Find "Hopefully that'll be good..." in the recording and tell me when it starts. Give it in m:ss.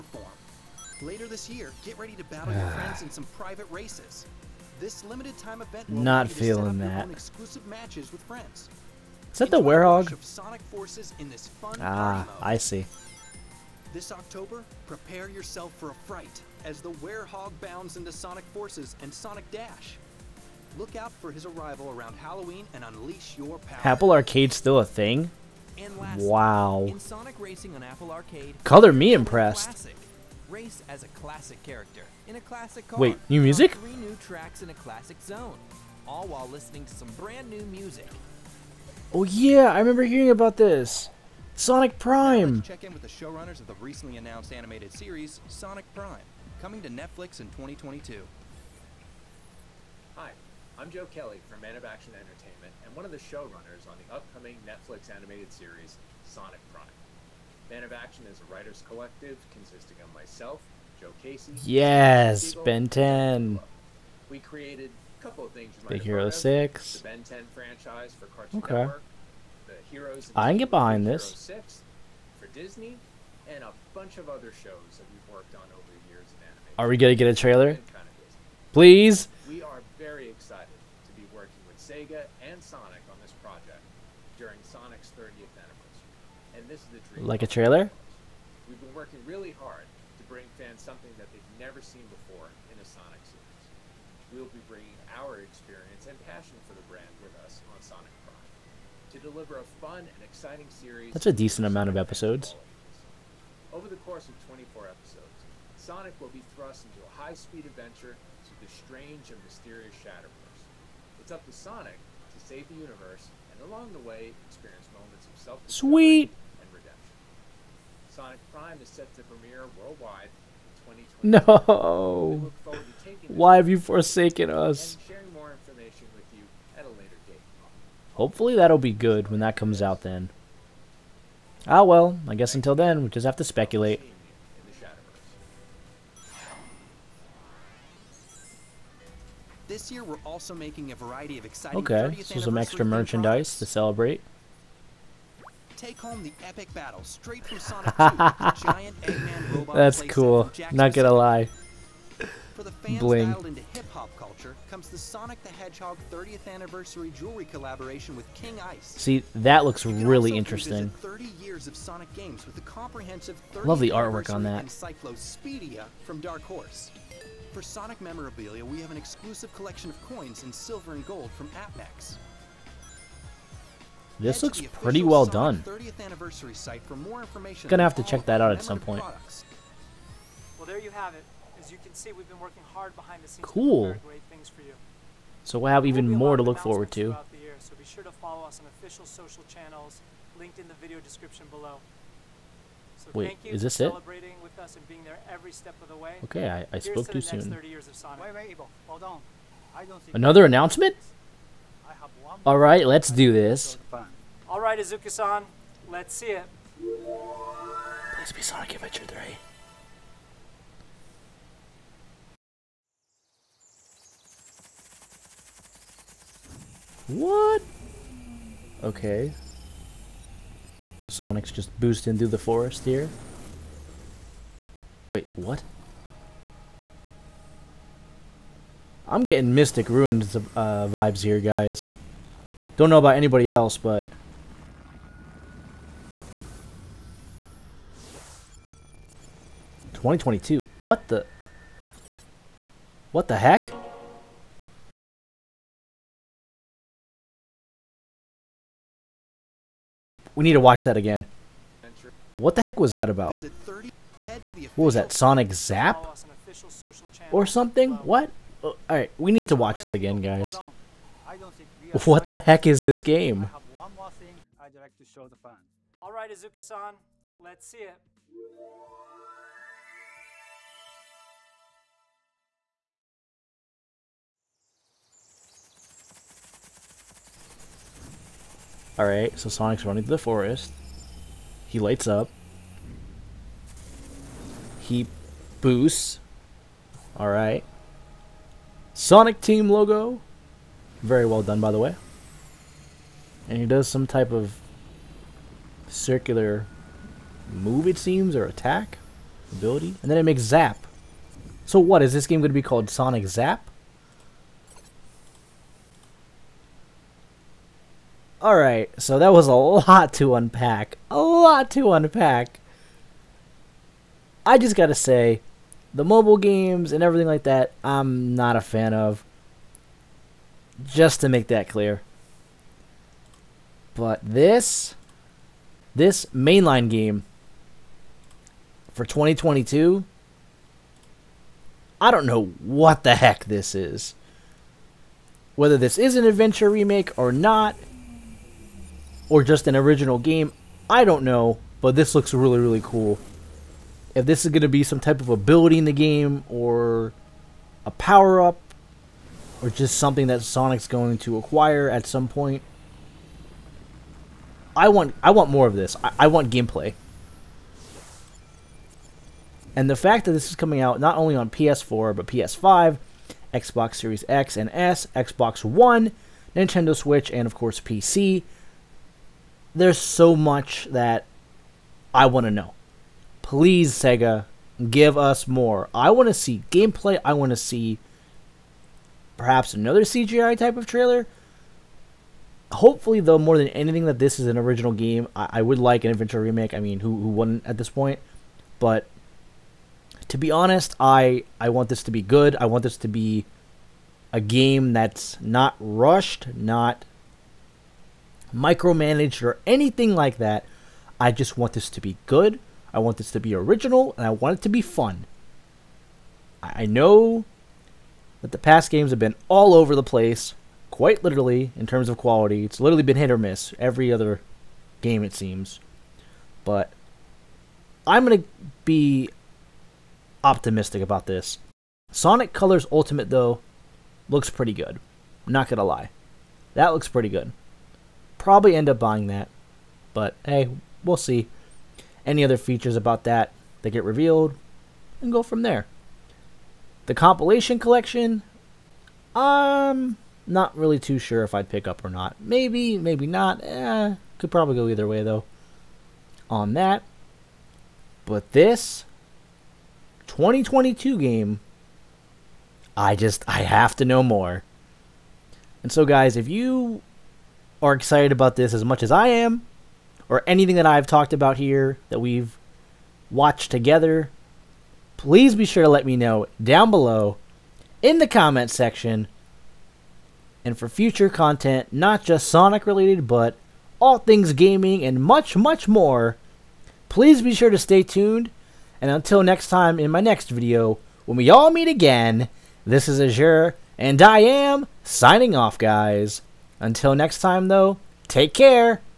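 2:08.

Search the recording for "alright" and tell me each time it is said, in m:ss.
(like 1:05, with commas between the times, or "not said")
3:24, 4:18, 4:26, 4:38, 4:47.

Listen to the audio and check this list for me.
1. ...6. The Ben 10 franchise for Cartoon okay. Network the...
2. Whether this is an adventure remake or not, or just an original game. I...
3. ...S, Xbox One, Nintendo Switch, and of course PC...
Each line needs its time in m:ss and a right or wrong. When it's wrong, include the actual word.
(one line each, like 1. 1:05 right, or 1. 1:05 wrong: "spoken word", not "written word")
1. 1:06 right
2. 5:35 right
3. 6:04 right.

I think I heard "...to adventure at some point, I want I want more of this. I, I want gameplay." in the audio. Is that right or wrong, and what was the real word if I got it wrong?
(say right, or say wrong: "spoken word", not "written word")
wrong: "acquire", not "adventure".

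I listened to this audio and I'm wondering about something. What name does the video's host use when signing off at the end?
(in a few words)
Azure.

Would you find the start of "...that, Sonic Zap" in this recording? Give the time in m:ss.
4:14.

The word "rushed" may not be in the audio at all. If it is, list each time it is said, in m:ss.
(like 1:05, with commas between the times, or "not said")
6:35.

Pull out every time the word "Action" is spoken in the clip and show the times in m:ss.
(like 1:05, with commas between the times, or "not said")
0:51, 0:57.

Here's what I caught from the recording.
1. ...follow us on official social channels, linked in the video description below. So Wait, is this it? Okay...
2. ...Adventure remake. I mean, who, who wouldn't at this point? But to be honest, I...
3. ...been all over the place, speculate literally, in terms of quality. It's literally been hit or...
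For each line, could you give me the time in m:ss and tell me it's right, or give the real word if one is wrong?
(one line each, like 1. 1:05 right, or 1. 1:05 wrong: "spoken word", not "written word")
1. 3:08 right
2. 6:26 right
3. 6:49 wrong: "quite", not "speculate".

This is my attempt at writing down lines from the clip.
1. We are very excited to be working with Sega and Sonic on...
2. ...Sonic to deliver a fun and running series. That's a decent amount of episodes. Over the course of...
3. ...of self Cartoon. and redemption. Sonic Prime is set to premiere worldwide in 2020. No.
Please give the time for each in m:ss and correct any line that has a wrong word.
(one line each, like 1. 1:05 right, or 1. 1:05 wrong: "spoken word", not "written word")
1. 1:19 right
2. 1:37 wrong: "exciting", not "running"
3. 1:55 wrong: "Sweet", not "Cartoon".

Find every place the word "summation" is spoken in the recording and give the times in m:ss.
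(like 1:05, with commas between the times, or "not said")
not said.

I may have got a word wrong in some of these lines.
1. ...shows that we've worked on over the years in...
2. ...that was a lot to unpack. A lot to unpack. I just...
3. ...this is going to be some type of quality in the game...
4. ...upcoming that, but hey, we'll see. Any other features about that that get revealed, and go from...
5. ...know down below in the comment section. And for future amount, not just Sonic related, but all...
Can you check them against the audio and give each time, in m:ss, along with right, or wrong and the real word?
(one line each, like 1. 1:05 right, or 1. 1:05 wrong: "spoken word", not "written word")
1. 1:14 right
2. 5:09 right
3. 5:44 wrong: "ability", not "quality"
4. 7:09 wrong: "buying", not "upcoming"
5. 7:46 wrong: "content", not "amount".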